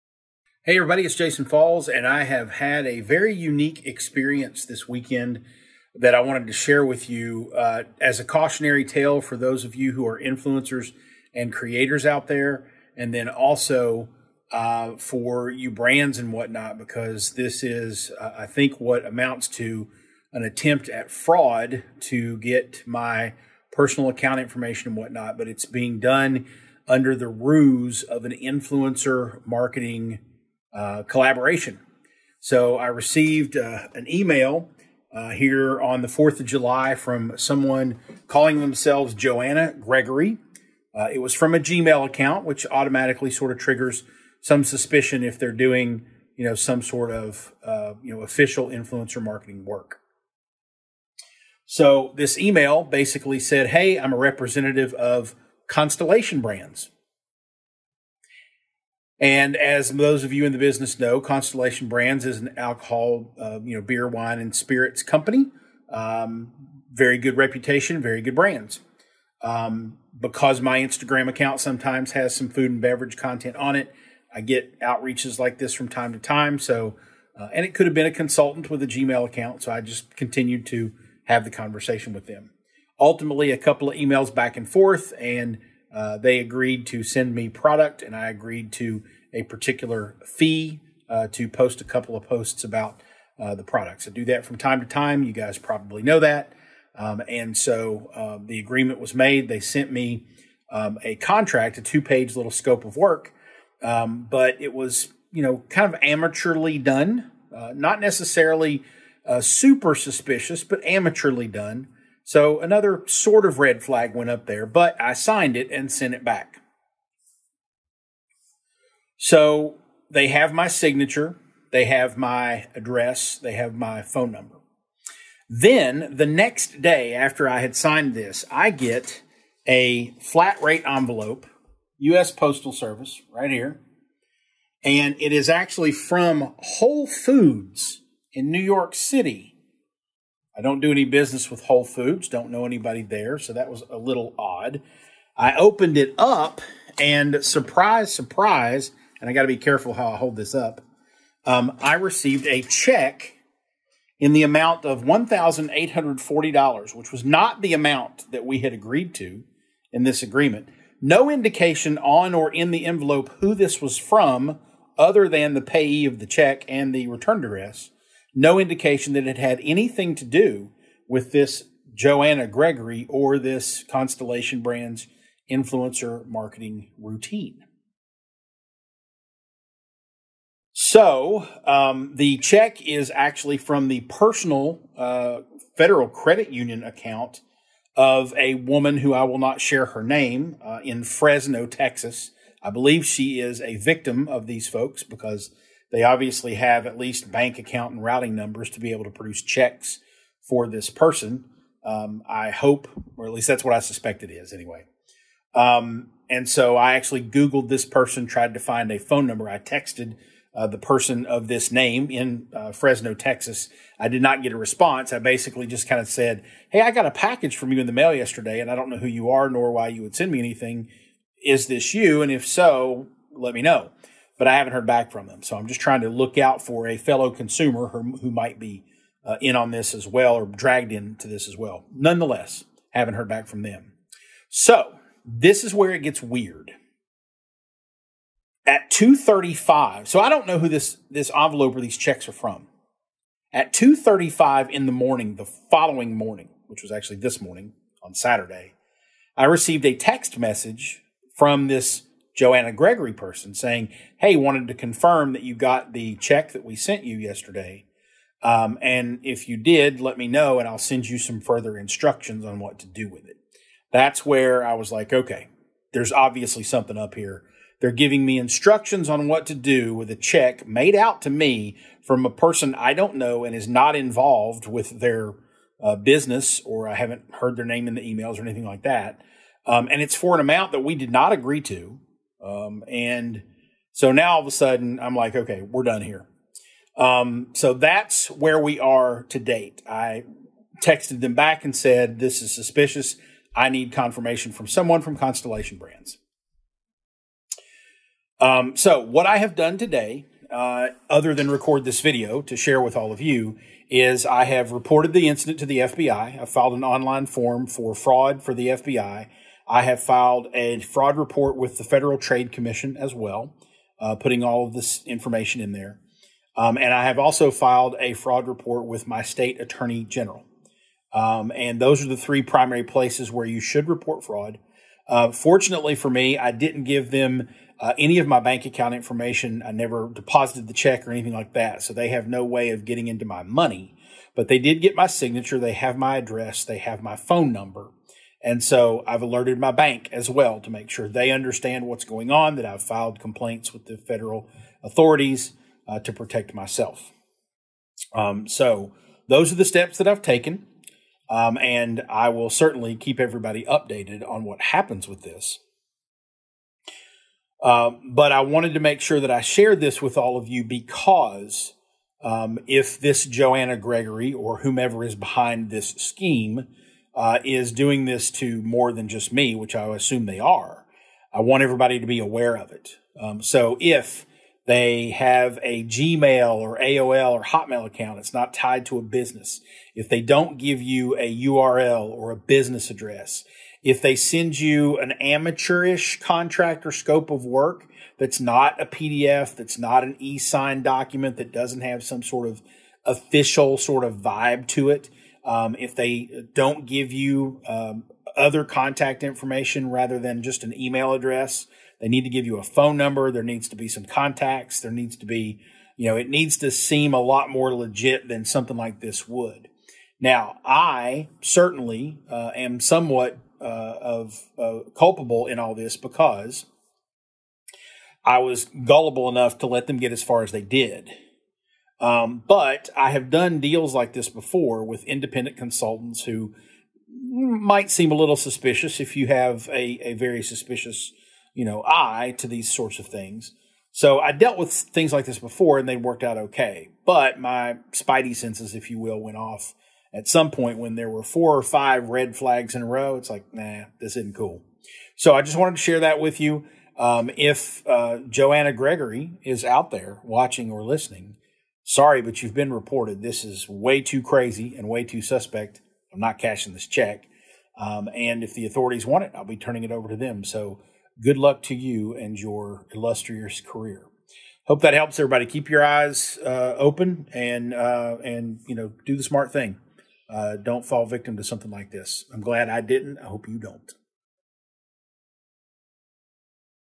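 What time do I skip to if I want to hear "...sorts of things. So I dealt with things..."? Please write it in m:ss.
7:12.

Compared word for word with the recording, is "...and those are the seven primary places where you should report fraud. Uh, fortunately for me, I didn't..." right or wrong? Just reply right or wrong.
wrong.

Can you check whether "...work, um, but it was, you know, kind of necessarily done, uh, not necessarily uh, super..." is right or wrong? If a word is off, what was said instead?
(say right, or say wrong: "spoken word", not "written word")
wrong: "amateurly", not "necessarily".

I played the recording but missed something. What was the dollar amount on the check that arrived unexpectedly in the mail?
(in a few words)
$1,840.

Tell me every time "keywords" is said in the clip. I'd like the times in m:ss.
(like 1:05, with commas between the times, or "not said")
not said.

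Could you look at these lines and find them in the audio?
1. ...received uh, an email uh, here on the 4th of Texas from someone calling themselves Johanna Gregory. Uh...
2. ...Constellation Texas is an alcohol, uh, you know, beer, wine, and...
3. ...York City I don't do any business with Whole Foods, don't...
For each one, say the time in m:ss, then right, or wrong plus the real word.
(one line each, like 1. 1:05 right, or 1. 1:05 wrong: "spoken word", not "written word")
1. 0:32 wrong: "July", not "Texas"
2. 1:01 wrong: "Brands", not "Texas"
3. 2:18 right.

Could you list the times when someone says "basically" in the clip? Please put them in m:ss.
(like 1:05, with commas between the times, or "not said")
0:52, 3:35.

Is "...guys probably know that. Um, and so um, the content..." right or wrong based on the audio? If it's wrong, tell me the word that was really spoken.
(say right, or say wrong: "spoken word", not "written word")
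wrong: "agreement", not "content".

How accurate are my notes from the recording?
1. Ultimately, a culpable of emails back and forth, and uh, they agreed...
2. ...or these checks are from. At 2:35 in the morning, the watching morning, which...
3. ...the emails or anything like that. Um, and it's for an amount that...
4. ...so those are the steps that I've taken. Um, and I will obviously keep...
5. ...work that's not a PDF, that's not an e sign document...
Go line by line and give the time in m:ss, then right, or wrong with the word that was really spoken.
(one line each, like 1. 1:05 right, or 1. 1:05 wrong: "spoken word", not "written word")
1. 1:22 wrong: "couple", not "culpable"
2. 4:01 wrong: "following", not "watching"
3. 4:37 right
4. 5:48 wrong: "certainly", not "obviously"
5. 6:27 right.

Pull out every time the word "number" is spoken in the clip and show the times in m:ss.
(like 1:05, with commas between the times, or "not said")
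2:04, 3:18, 3:29, 5:37, 6:42.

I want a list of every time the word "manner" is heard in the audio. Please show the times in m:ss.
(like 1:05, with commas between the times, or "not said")
not said.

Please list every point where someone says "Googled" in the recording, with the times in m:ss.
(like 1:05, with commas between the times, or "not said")
3:27.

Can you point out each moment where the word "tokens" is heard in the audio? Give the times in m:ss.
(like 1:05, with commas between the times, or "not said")
not said.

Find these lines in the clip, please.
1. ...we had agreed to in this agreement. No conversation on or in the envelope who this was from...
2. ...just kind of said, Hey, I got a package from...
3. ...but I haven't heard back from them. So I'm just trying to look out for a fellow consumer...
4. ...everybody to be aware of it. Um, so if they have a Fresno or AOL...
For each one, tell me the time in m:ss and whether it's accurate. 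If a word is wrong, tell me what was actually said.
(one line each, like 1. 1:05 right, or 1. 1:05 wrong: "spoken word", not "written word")
1. 2:38 wrong: "indication", not "conversation"
2. 3:35 right
3. 3:44 right
4. 6:11 wrong: "Gmail", not "Fresno".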